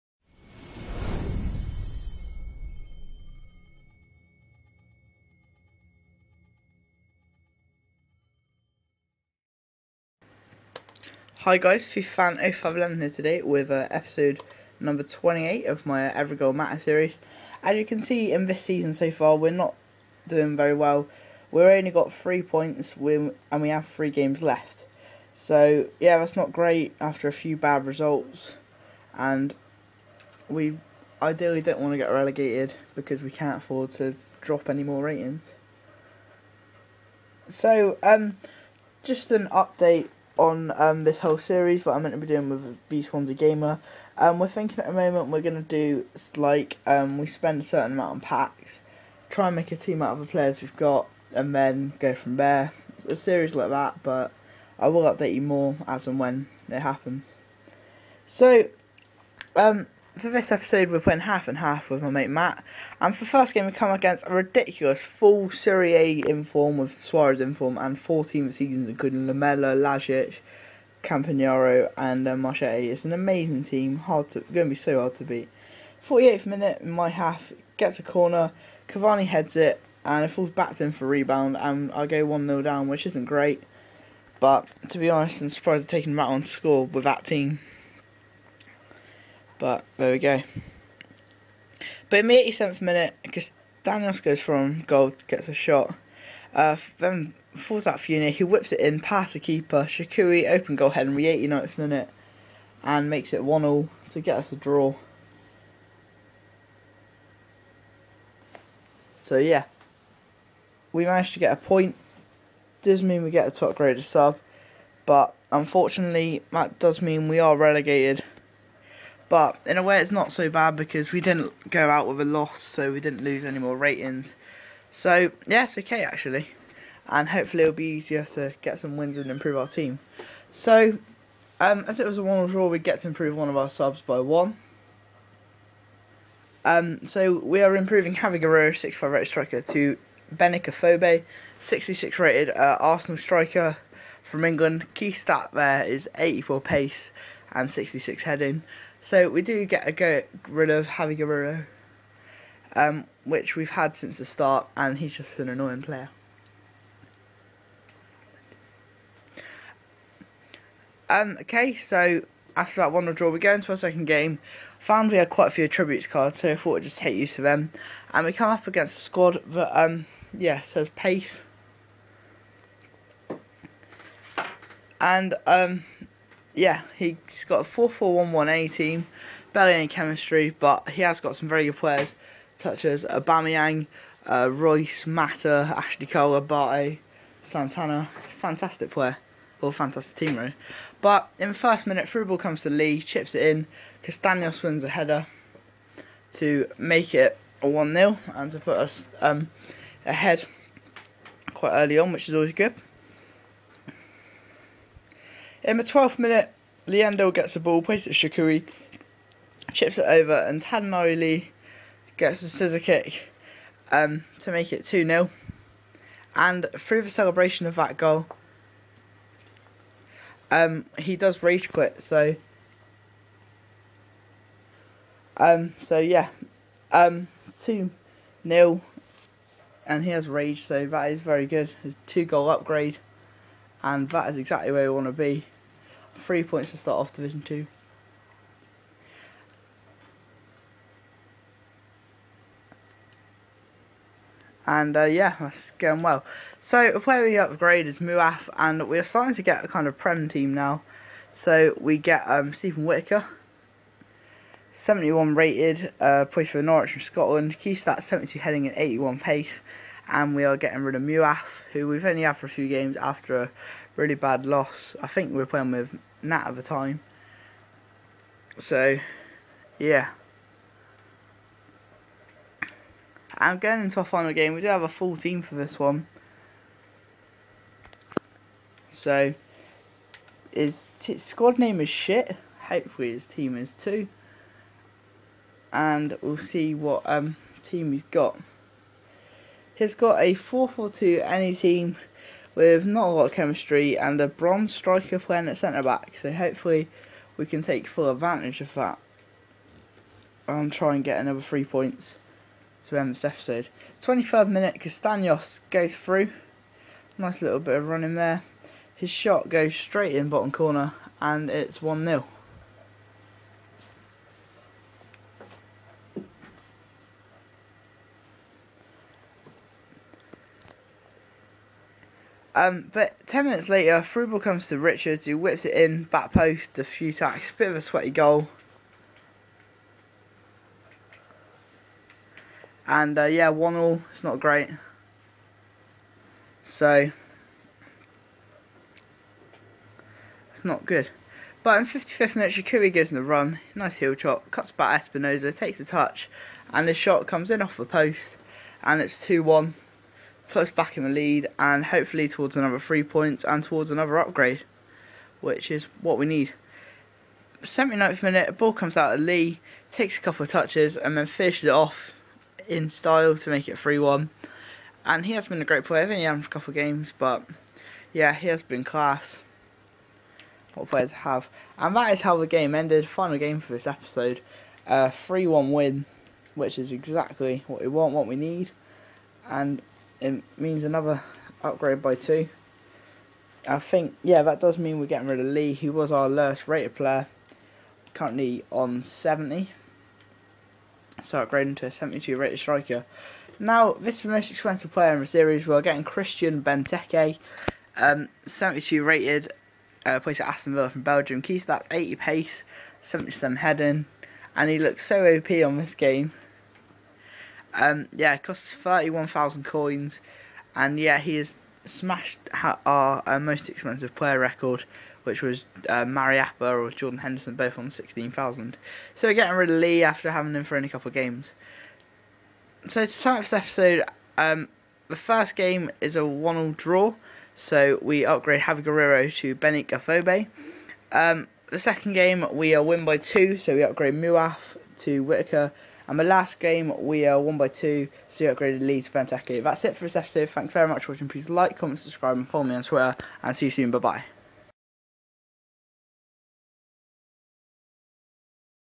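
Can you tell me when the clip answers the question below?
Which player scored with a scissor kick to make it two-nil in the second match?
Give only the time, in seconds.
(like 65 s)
210 s.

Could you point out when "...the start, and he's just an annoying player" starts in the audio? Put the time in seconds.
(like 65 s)
154 s.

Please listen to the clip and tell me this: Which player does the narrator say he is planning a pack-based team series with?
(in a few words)
B Swansea Gamer.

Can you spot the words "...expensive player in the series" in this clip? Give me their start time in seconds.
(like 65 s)
394 s.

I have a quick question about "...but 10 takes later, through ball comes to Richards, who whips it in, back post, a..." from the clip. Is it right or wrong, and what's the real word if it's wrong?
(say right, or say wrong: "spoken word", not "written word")
wrong: "minutes", not "takes".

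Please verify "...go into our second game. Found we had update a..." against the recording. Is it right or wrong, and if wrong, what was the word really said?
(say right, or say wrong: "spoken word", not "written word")
wrong: "quite", not "update".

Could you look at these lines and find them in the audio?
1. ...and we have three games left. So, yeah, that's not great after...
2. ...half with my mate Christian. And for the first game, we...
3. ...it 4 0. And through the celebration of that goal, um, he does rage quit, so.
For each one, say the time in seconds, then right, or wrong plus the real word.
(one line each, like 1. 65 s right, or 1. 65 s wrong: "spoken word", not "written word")
1. 23 s right
2. 61 s wrong: "Matt", not "Christian"
3. 214 s wrong: "2", not "4".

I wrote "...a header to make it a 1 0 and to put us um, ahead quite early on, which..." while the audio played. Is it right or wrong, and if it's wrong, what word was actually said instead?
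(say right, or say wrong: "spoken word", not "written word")
right.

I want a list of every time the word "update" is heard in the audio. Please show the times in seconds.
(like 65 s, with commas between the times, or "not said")
39 s, 55 s.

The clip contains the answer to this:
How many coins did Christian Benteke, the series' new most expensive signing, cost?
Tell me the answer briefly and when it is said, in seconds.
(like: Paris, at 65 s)
31,000, at 408 s.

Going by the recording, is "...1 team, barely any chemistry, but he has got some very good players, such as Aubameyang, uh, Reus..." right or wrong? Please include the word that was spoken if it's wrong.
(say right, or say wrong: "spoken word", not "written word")
right.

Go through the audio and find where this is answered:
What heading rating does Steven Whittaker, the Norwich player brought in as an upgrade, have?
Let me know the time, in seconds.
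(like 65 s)
258 s.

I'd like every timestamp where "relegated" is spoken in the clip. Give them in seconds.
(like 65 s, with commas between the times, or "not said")
32 s, 117 s.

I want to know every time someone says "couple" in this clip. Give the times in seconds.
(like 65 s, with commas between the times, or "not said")
360 s, 366 s, 420 s.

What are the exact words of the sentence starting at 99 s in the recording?
Shaqiri, open goal, Henry, 89th minute, and makes it 1 0 to get us a draw.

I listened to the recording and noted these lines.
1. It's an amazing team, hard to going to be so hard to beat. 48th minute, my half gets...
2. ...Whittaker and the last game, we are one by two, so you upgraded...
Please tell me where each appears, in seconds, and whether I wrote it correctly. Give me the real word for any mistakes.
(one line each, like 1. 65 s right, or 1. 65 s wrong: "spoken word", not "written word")
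1. 72 s right
2. 435 s right.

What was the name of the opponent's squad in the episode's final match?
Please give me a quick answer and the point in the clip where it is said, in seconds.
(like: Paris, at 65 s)
shit, at 281 s.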